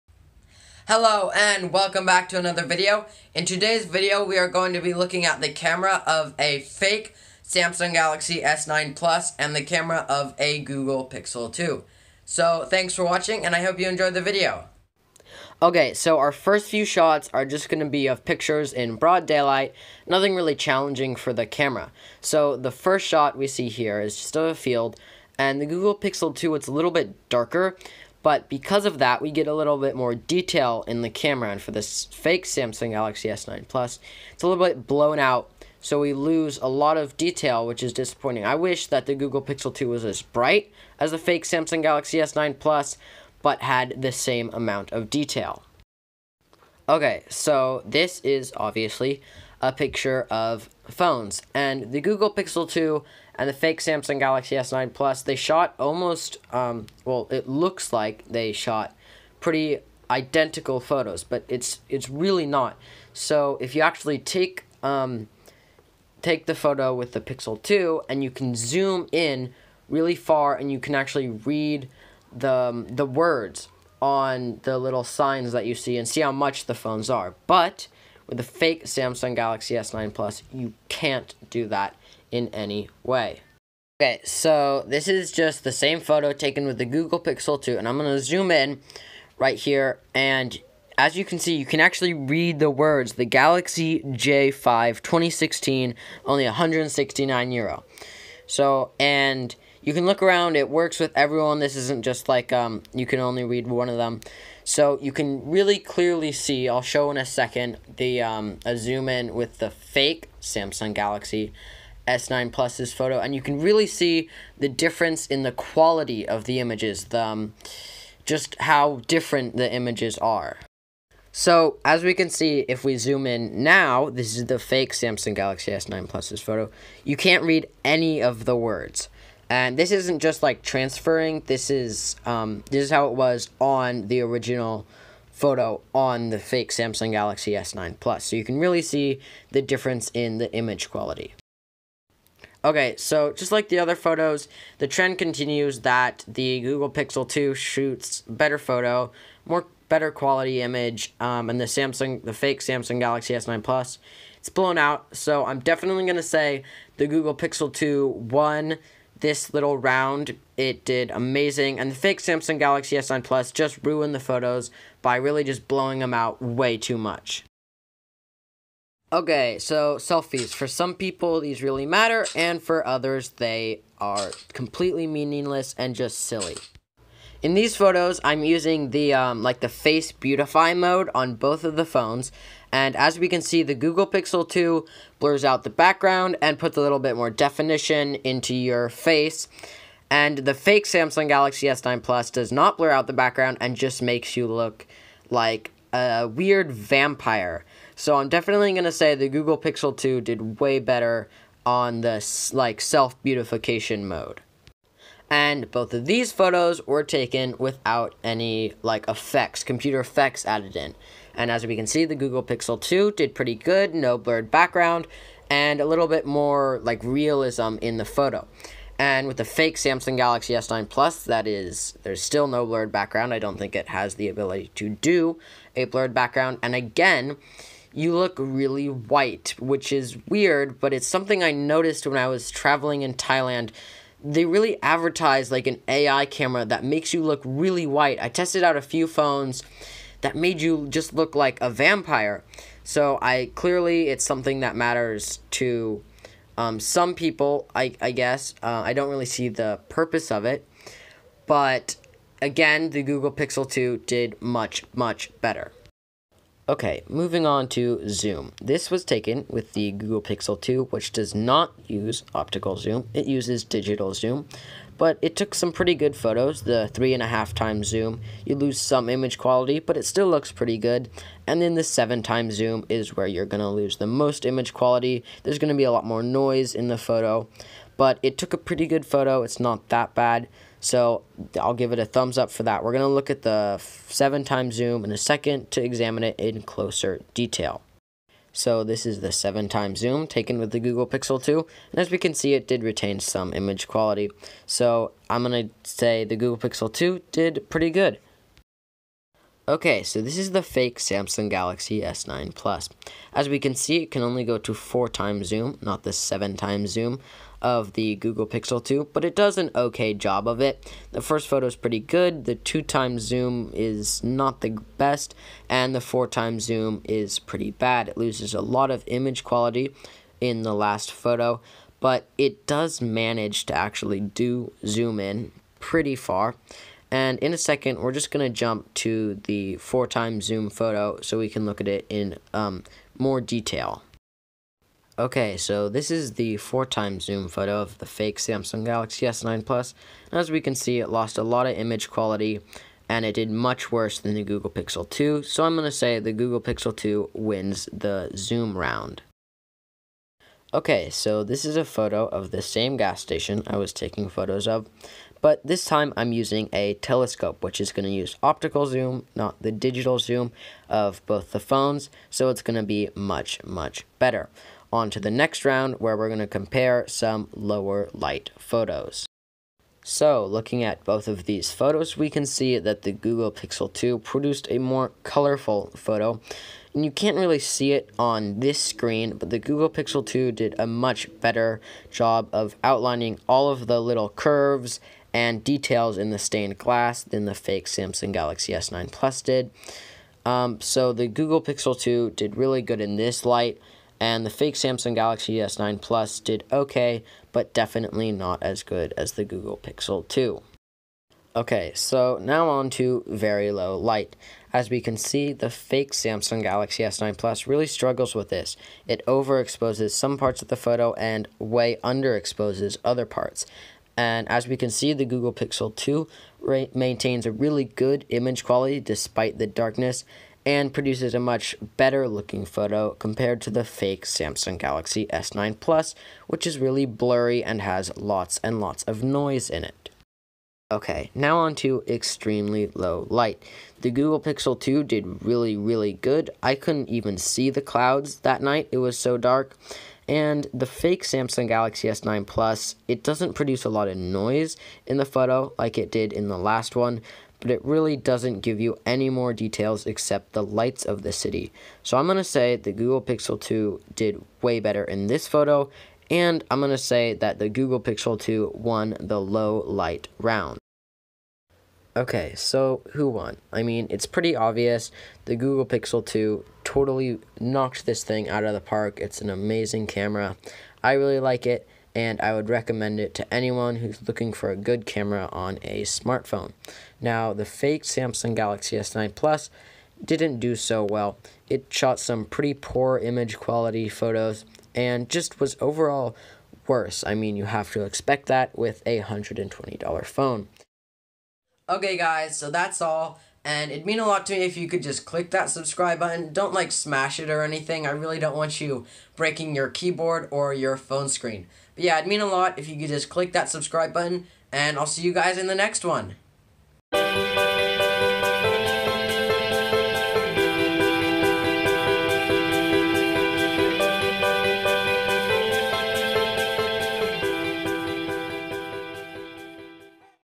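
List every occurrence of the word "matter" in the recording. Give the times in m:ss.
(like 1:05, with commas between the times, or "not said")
2:51, 4:04.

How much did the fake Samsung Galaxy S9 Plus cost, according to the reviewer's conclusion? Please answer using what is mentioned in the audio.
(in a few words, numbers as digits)
$120.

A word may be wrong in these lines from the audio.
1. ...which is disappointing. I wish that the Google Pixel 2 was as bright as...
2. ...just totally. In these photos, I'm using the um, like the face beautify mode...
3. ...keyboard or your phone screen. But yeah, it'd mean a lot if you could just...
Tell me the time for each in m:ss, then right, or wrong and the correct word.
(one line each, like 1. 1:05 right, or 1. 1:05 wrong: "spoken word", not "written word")
1. 0:37 right
2. 2:55 wrong: "silly", not "totally"
3. 8:19 right.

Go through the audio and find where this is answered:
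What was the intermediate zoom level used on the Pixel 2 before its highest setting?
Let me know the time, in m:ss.
4:26.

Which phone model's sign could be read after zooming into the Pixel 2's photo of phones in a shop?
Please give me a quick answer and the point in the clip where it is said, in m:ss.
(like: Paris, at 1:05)
Galaxy J5 2016, at 1:33.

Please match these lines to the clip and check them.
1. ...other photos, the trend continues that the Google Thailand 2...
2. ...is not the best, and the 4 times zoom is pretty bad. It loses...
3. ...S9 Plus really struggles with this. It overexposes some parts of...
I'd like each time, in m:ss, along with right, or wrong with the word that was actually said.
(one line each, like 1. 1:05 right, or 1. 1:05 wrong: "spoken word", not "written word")
1. 2:23 wrong: "Pixel", not "Thailand"
2. 5:13 right
3. 6:47 right.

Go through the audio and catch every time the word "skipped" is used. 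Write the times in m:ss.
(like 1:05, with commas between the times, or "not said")
not said.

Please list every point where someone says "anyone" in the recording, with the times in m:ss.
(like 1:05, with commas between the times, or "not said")
7:53.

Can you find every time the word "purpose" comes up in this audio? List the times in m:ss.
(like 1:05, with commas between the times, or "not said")
4:09.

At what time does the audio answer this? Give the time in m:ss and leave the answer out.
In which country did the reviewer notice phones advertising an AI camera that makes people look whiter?
3:53.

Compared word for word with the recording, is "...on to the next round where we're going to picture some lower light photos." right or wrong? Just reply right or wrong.
wrong.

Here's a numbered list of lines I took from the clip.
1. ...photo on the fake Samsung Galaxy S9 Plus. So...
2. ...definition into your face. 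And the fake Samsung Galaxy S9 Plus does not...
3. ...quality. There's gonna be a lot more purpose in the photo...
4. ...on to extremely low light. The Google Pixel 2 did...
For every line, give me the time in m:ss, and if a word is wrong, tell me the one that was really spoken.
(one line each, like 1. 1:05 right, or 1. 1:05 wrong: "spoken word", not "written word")
1. 2:15 right
2. 3:07 right
3. 4:34 wrong: "noise", not "purpose"
4. 7:11 right.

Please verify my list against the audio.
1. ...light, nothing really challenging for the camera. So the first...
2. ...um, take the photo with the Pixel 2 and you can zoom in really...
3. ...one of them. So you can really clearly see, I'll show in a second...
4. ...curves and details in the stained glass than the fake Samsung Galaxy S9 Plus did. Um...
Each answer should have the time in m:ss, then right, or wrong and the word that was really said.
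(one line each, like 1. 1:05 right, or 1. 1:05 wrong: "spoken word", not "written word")
1. 0:19 wrong: "daylight", not "light"
2. 1:04 right
3. 1:43 right
4. 6:24 right.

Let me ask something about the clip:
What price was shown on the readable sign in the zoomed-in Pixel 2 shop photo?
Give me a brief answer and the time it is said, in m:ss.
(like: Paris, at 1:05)
169 euro, at 1:36.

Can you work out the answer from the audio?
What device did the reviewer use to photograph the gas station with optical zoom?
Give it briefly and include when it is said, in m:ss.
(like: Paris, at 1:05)
a telescope, at 5:56.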